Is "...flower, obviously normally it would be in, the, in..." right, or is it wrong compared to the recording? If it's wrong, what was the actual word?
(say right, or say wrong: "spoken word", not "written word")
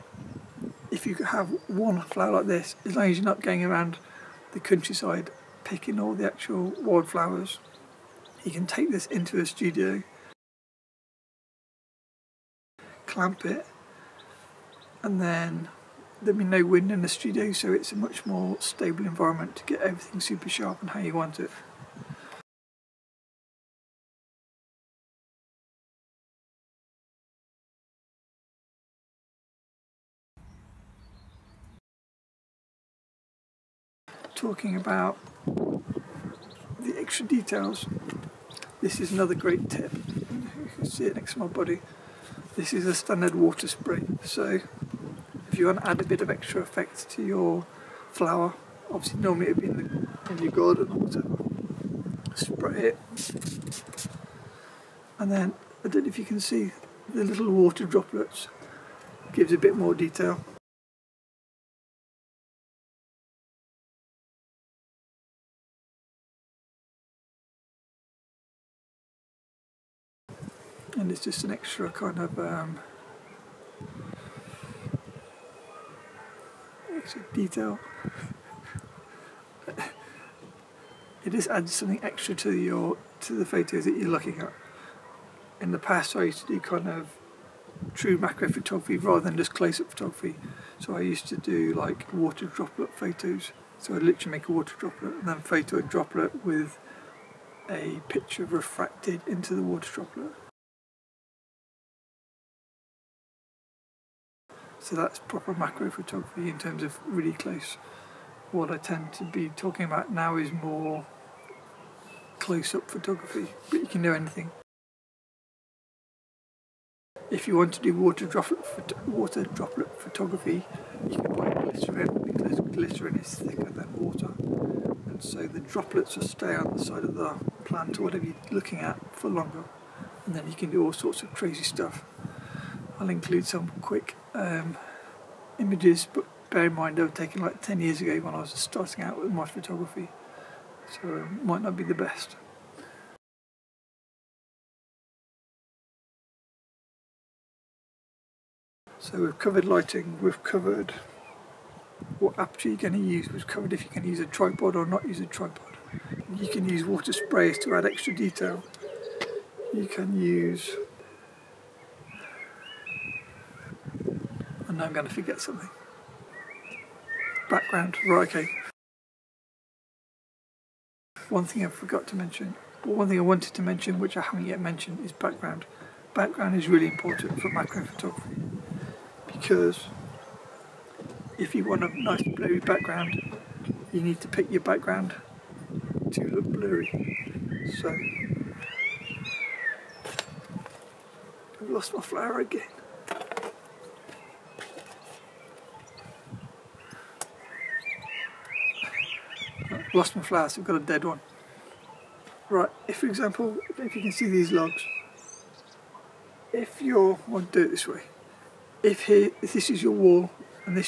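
right.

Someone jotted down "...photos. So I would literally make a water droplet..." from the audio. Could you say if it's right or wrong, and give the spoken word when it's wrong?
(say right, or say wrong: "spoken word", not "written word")
right.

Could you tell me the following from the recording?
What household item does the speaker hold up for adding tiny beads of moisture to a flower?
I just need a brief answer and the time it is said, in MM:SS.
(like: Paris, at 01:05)
Water spray, at 00:43.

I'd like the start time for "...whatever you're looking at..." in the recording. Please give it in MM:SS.
02:08.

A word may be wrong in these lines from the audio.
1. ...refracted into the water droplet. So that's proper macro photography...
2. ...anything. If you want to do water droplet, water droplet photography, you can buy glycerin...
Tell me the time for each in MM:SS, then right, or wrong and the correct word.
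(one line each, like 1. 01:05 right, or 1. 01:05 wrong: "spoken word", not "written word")
1. 01:38 right
2. 01:54 right.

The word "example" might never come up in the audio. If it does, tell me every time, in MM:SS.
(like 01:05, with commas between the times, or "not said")
03:23.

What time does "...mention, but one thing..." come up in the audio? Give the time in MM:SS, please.
02:52.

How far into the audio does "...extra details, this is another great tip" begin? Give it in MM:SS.
00:36.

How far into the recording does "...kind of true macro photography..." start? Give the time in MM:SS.
01:26.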